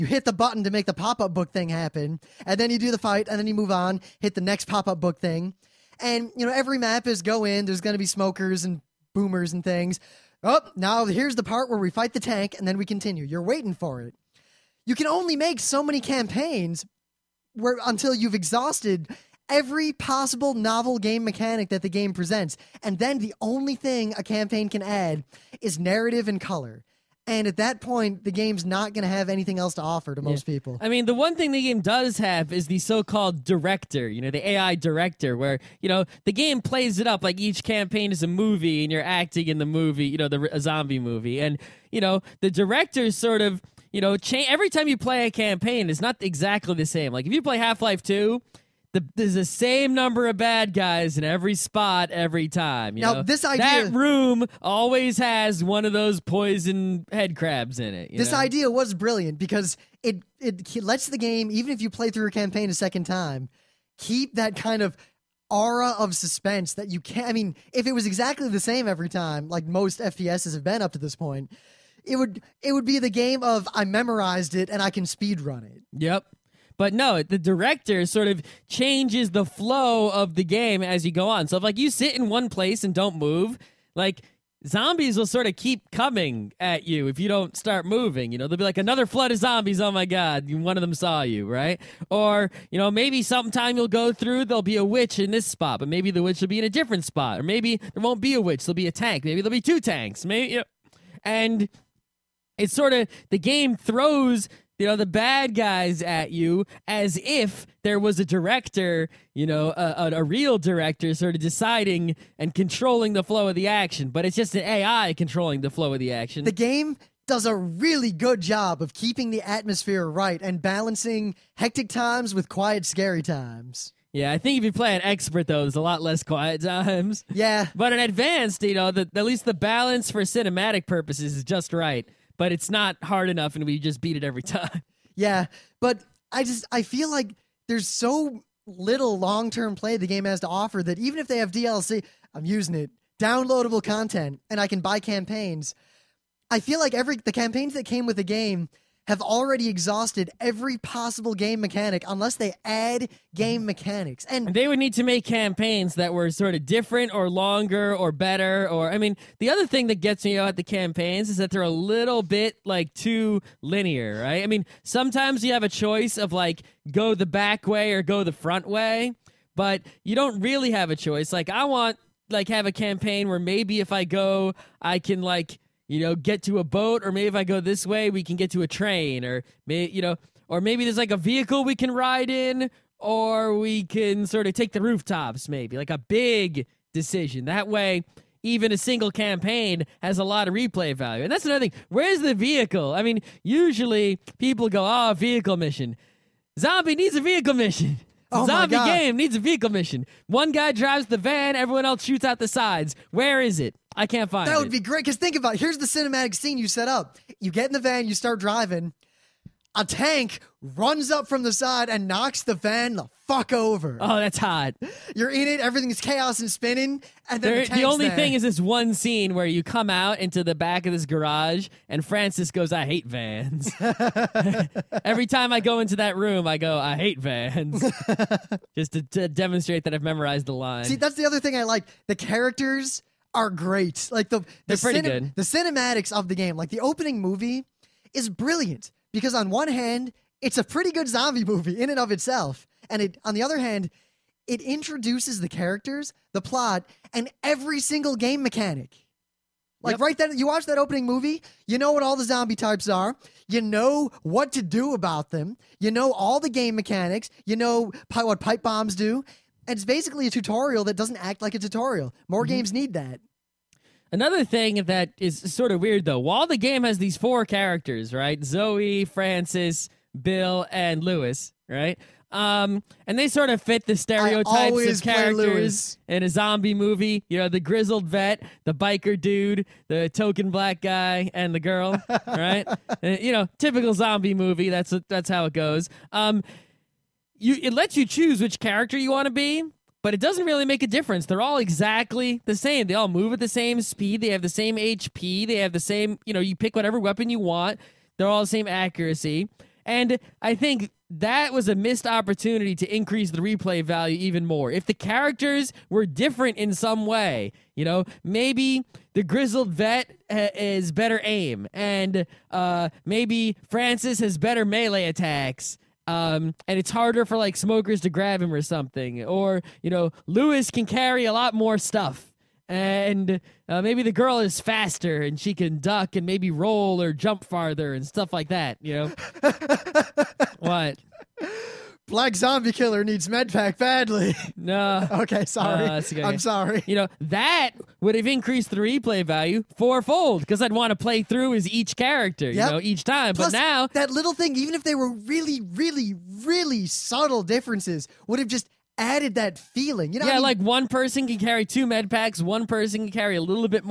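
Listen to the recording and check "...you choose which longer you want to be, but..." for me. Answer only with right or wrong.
wrong.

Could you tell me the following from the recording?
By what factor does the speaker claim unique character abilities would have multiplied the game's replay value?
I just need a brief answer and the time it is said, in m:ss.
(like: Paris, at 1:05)
fourfold, at 5:39.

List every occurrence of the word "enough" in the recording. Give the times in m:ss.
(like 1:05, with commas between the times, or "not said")
2:13.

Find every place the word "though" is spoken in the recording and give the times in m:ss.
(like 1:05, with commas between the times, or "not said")
2:05, 4:26.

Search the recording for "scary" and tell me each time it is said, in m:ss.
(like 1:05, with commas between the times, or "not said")
2:02.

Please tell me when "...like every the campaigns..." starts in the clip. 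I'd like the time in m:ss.
2:26.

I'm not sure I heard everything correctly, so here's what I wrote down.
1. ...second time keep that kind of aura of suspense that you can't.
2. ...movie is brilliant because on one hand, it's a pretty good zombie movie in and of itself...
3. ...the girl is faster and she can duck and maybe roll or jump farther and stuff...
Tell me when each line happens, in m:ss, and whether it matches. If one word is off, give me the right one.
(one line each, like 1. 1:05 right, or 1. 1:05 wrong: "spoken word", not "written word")
1. 1:02 right
2. 3:57 right
3. 5:24 right.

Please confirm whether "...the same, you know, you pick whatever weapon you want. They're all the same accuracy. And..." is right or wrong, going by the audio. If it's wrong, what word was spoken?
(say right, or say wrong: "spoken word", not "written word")
right.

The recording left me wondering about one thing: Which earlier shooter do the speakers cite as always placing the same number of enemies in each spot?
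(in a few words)
Half Life 2.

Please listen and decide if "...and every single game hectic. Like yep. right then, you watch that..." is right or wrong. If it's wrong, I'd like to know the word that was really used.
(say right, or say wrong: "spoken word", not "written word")
wrong: "mechanic", not "hectic".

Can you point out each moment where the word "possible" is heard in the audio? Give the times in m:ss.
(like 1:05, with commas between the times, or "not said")
0:19, 2:30.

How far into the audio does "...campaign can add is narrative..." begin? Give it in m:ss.
0:24.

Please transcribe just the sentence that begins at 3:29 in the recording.
A tank runs up from the side and knocks the van the fuck over.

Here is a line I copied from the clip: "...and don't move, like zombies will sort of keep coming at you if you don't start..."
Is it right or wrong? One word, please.
right.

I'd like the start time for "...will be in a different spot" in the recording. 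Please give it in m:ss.
1:36.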